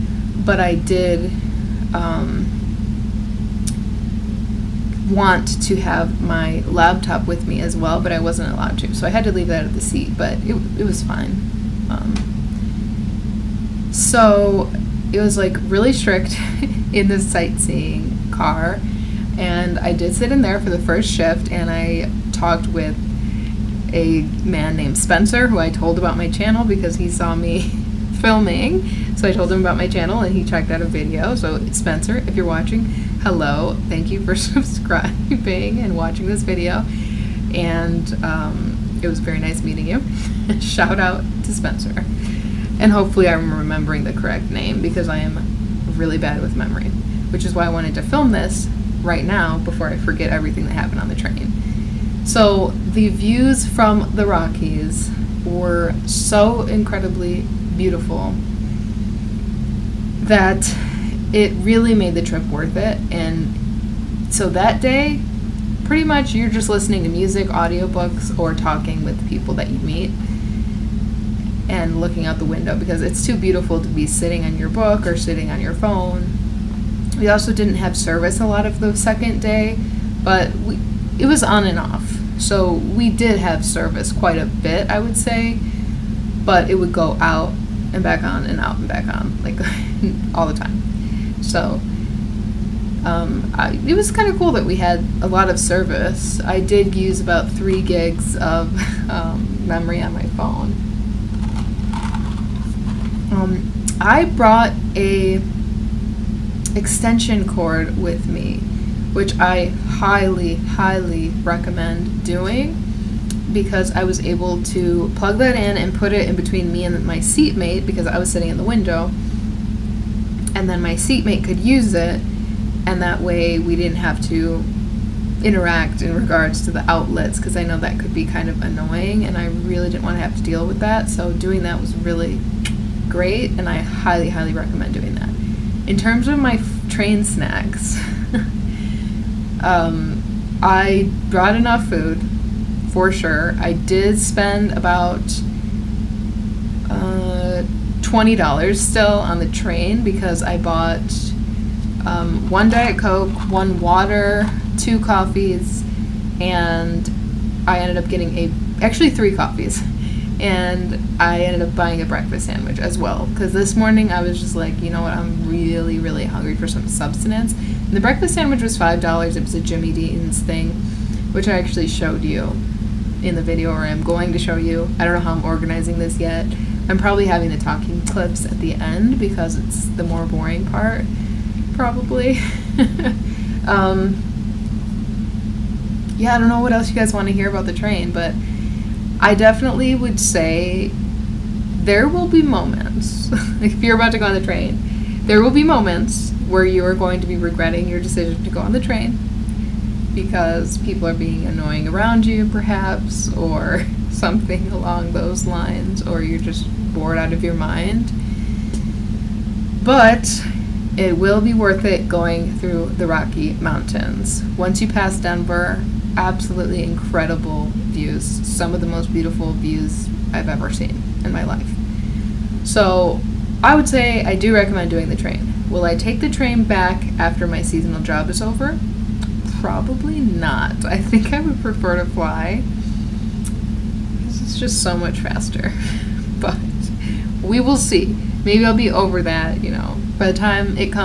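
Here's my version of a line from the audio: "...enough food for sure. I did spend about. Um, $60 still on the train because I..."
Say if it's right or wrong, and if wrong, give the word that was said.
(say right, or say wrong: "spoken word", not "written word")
wrong: "20", not "60".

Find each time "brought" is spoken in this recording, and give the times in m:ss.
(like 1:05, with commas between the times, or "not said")
1:44, 2:21.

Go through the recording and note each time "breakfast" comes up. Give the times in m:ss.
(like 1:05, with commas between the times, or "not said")
2:42, 2:47.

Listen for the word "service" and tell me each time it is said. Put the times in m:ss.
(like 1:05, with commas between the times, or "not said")
1:17, 1:23, 1:35.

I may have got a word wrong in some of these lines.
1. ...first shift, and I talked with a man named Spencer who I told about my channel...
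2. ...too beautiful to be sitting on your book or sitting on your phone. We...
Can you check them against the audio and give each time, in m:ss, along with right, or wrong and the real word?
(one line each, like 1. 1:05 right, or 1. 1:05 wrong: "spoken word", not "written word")
1. 0:20 right
2. 1:13 right.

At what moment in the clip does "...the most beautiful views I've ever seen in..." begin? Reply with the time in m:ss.
3:38.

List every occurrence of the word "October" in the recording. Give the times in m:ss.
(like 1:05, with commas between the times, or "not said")
not said.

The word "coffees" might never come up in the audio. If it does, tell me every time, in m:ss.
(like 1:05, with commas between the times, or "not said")
2:34, 2:39.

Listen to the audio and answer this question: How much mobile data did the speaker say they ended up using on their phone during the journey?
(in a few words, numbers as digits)
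3 gigs.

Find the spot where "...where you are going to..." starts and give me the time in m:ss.
3:16.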